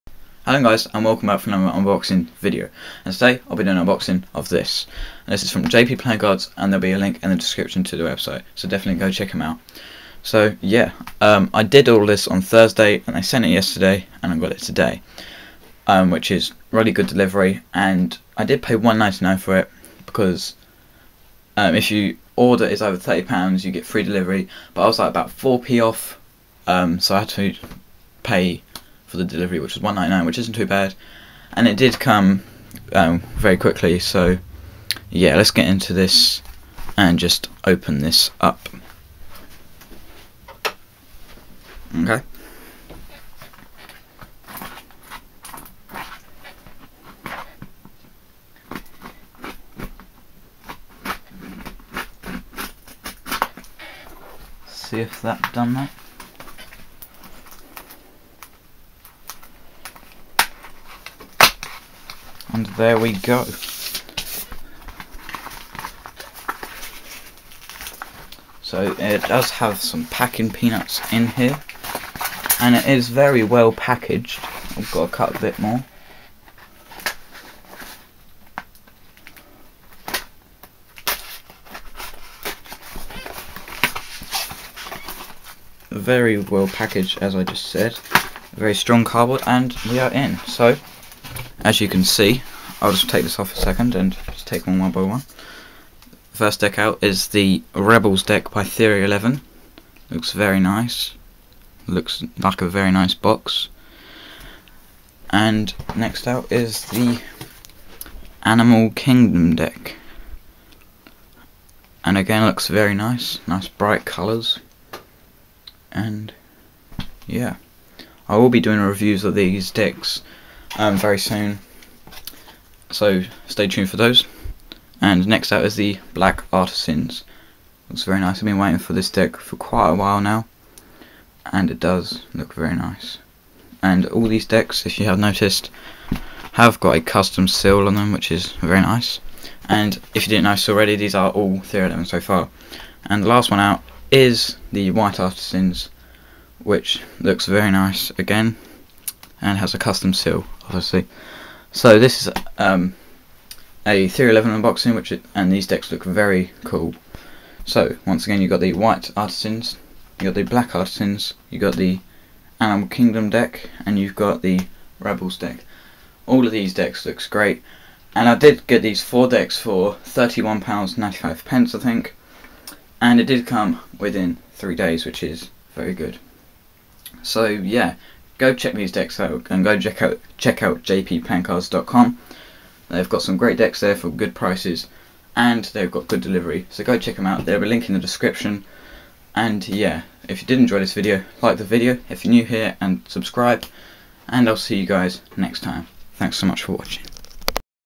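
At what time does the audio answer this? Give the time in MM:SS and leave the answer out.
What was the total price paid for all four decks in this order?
02:50.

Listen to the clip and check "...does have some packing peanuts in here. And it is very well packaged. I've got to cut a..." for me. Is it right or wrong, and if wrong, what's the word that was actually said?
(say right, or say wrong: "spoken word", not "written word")
right.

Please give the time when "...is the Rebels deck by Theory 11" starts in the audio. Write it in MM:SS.
01:37.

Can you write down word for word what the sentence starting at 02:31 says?
So this is um, a Theory 11 unboxing, which it, and these decks look very cool.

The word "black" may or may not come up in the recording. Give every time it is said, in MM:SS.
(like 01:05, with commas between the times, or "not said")
02:06, 02:40.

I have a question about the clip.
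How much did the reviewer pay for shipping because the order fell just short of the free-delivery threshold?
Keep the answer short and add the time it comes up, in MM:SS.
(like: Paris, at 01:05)
£1.99, at 00:29.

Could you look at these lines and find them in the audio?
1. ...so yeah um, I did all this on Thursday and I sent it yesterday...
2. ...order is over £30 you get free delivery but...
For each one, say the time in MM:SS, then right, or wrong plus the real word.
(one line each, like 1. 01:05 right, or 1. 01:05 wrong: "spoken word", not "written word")
1. 00:10 right
2. 00:22 right.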